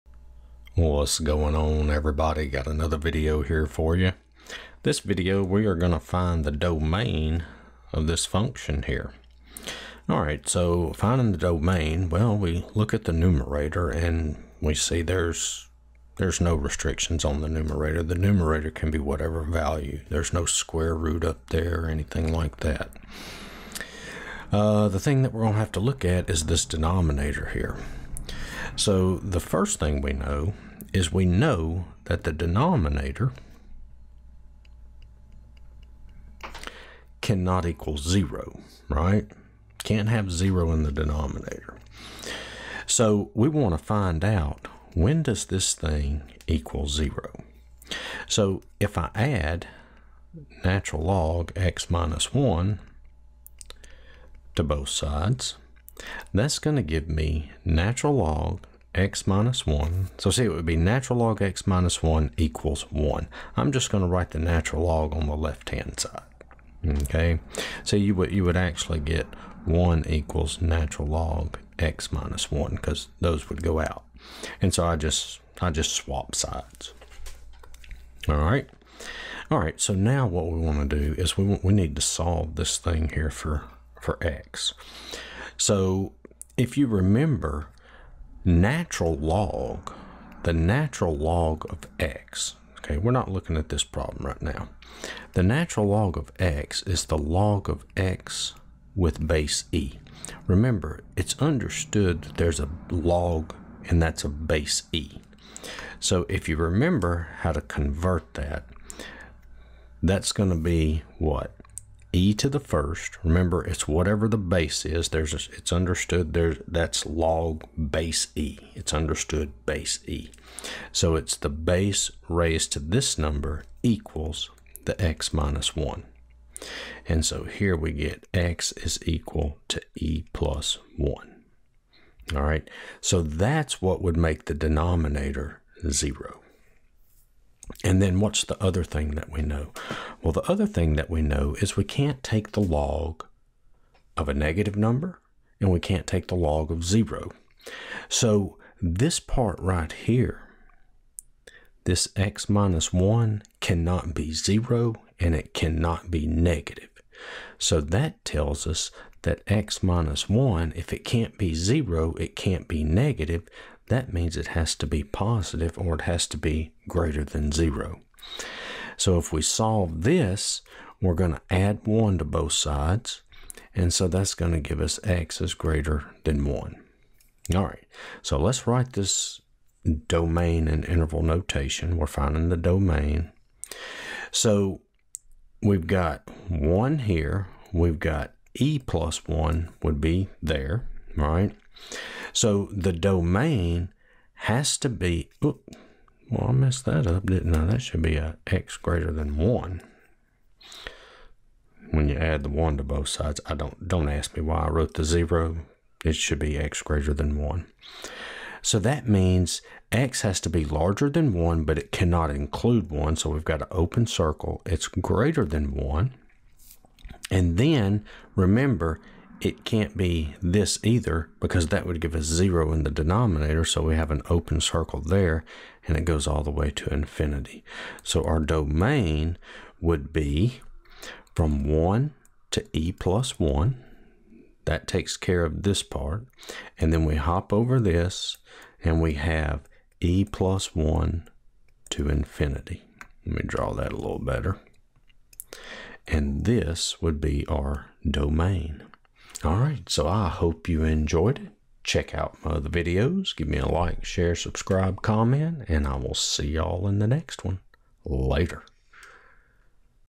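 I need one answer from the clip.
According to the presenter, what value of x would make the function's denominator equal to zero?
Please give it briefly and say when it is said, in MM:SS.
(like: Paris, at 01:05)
e + 1, at 02:08.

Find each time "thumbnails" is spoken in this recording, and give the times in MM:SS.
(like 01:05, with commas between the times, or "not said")
not said.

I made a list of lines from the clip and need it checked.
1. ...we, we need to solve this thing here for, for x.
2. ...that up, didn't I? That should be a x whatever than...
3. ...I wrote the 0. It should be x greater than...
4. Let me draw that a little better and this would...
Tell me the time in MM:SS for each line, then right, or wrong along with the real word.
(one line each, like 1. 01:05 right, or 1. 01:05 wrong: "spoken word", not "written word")
1. 01:21 right
2. 03:16 wrong: "greater", not "whatever"
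3. 03:24 right
4. 04:03 right.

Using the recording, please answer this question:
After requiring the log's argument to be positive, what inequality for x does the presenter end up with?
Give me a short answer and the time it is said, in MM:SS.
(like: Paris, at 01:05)
x > 1, at 02:55.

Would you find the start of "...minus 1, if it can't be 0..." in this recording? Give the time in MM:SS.
02:39.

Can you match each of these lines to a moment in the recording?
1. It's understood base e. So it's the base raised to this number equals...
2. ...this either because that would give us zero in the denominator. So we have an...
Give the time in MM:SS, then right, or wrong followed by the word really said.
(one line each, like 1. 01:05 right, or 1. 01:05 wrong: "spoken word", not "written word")
1. 01:58 right
2. 03:40 right.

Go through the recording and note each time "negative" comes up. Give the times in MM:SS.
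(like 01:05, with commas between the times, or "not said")
02:24, 02:36, 02:42.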